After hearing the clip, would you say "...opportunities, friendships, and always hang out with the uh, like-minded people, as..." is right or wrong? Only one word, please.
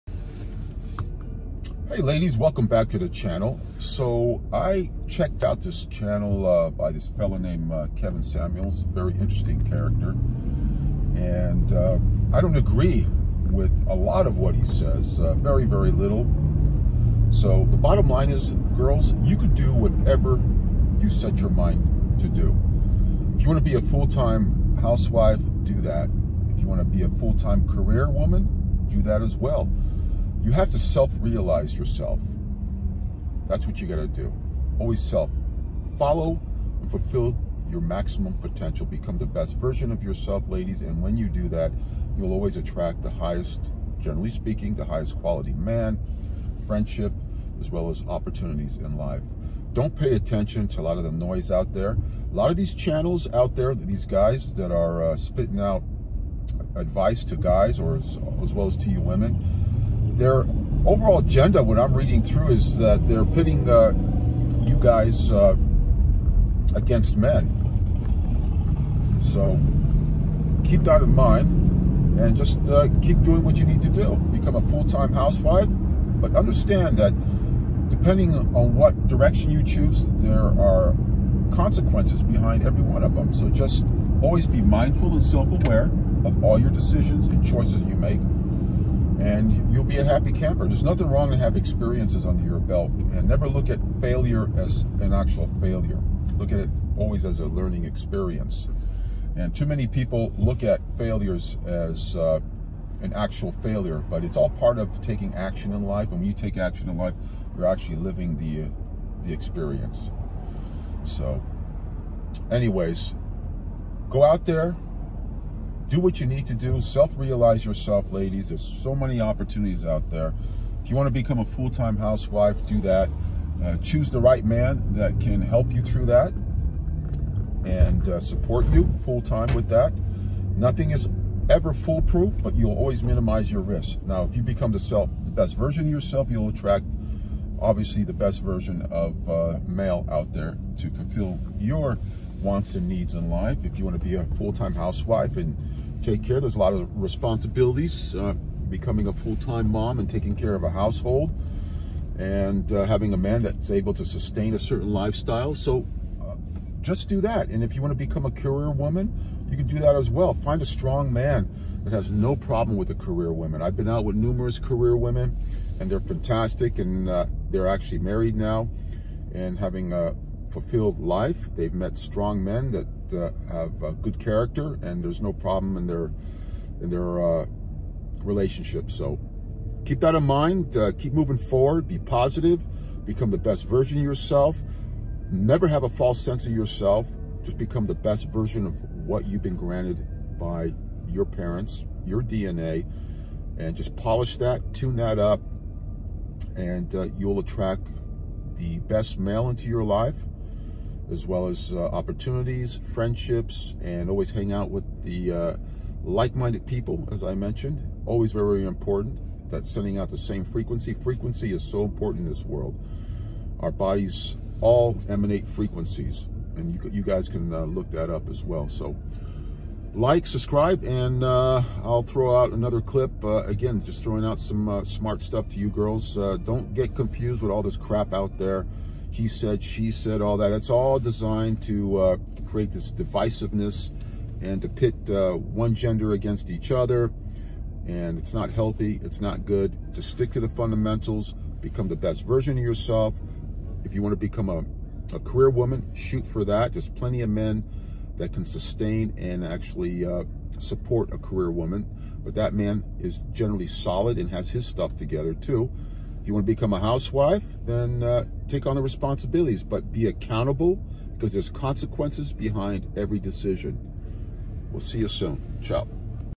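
right.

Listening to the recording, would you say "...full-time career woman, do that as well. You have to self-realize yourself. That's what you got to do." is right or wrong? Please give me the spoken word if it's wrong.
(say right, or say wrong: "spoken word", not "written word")
right.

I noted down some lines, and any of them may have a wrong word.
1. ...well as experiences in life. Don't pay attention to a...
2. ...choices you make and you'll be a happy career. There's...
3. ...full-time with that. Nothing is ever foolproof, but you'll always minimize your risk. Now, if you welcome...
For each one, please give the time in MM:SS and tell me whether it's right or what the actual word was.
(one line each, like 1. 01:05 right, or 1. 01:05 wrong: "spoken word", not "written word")
1. 00:47 wrong: "opportunities", not "experiences"
2. 01:27 wrong: "camper", not "career"
3. 02:09 wrong: "become", not "welcome".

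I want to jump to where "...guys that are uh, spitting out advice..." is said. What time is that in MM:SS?
00:54.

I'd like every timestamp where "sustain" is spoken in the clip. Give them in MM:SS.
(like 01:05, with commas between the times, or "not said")
02:34, 04:08.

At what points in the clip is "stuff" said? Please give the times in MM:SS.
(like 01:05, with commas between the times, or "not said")
03:45, 04:14.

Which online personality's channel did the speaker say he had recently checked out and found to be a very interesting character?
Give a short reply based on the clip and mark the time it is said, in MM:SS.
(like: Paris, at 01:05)
Kevin Samuels, at 00:07.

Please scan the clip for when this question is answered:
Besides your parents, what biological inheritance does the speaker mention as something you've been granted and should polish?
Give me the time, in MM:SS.
03:12.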